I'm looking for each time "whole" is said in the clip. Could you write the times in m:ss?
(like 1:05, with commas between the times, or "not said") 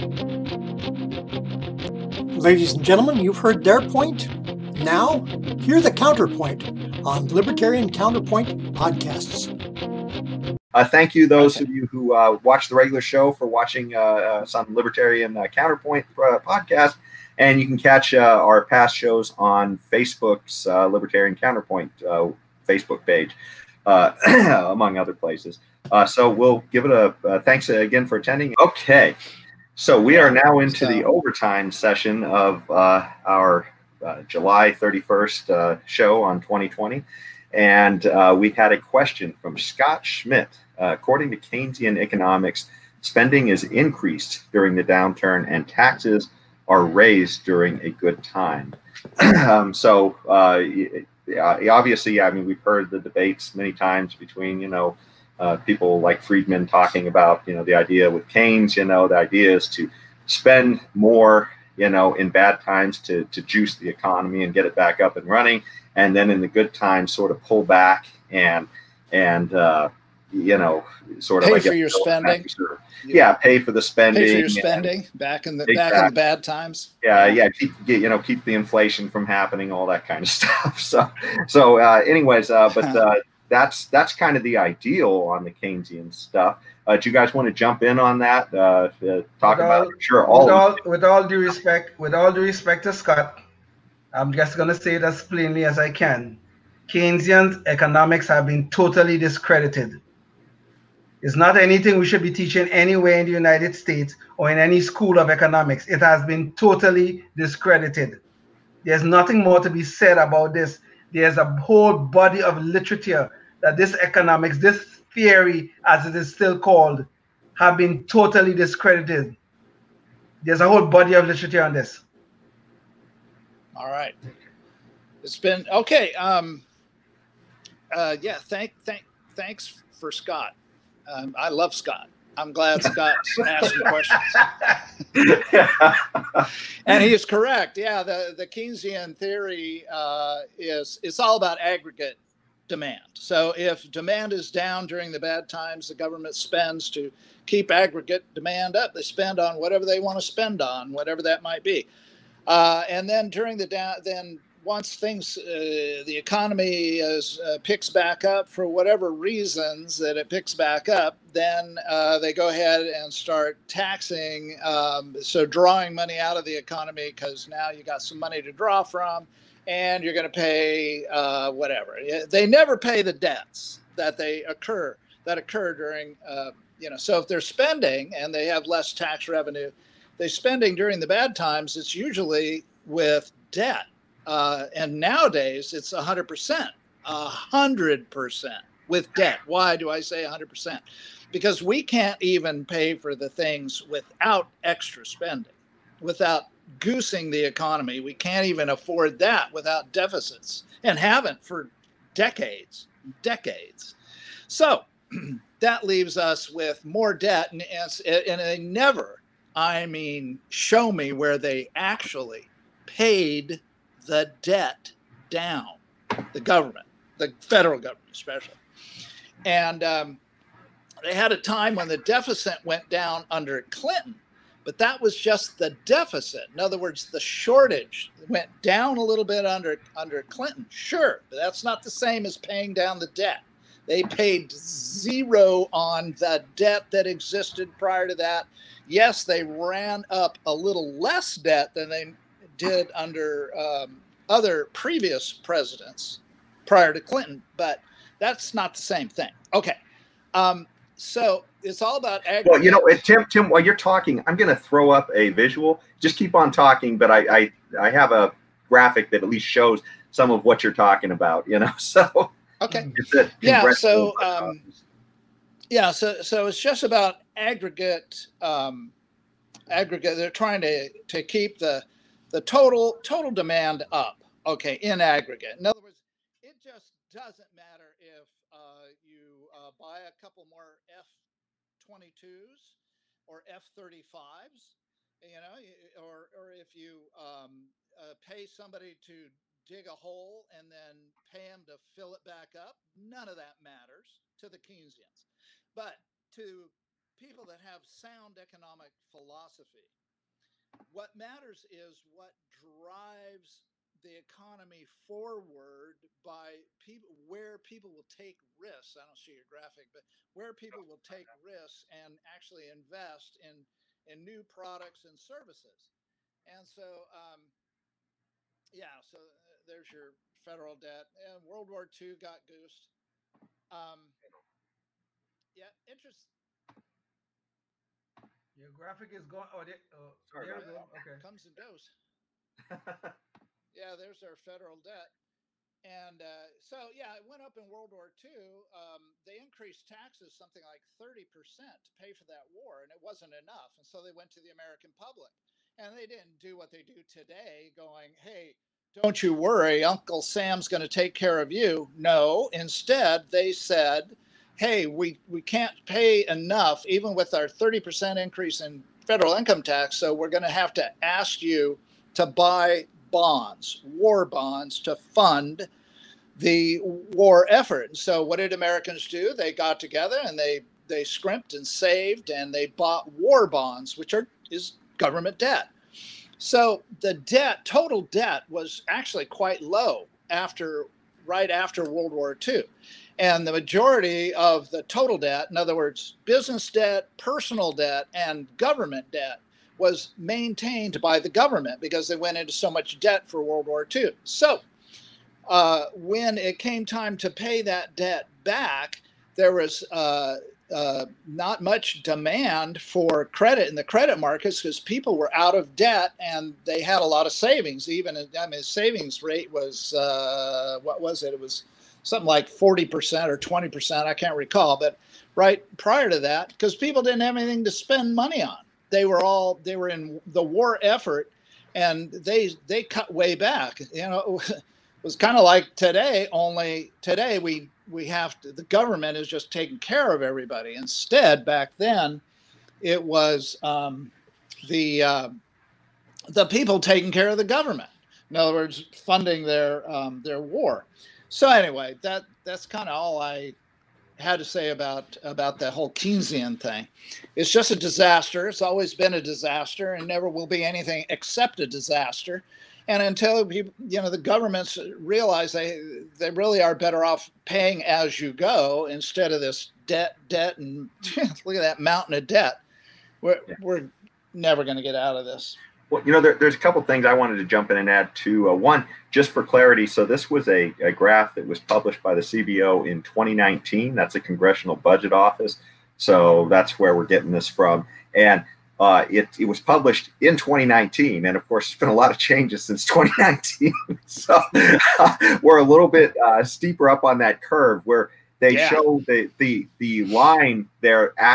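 1:51, 2:00, 7:25.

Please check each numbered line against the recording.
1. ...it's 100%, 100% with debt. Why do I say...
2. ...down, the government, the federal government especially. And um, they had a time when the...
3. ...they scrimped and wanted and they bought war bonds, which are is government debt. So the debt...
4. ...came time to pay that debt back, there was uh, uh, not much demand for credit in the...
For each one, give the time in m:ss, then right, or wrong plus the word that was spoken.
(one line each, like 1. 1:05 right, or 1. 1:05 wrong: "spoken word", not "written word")
1. 3:05 right
2. 3:35 right
3. 6:10 wrong: "saved", not "wanted"
4. 6:36 right.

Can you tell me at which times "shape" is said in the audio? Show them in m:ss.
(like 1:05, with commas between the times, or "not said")
not said.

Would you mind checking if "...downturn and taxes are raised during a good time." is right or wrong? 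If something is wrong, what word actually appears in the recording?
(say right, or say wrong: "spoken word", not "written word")
right.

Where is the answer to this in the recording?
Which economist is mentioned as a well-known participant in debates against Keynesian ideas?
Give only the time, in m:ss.
0:56.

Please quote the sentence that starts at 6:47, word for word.
Even I mean, savings rate was uh, what was it?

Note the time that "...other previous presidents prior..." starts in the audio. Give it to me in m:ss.
4:04.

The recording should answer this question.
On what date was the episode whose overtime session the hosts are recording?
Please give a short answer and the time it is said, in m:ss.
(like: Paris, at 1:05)
July 31st, at 0:34.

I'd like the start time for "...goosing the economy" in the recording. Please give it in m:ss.
3:16.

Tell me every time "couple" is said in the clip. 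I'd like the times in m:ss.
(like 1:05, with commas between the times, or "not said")
4:40, 7:46.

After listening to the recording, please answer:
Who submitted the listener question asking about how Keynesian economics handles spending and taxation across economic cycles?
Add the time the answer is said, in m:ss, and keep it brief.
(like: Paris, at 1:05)
Scott Schmidt, at 0:39.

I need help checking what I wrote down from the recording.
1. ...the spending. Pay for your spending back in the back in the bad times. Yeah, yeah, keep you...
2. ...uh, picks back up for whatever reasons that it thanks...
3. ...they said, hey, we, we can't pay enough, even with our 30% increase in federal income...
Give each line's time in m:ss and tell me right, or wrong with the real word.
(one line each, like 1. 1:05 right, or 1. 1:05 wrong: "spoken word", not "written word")
1. 1:13 right
2. 2:37 wrong: "picks", not "thanks"
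3. 5:53 right.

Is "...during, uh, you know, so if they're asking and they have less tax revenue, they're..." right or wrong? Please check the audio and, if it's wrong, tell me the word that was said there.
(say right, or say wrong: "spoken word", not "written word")
wrong: "spending", not "asking".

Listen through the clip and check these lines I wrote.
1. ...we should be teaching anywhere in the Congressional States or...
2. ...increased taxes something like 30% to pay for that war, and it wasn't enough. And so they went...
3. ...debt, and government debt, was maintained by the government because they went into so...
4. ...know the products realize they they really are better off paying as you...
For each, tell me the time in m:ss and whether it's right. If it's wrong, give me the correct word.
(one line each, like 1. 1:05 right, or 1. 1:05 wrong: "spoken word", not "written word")
1. 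1:41 wrong: "United", not "Congressional"
2. 5:39 right
3. 6:27 right
4. 7:33 wrong: "governments", not "products".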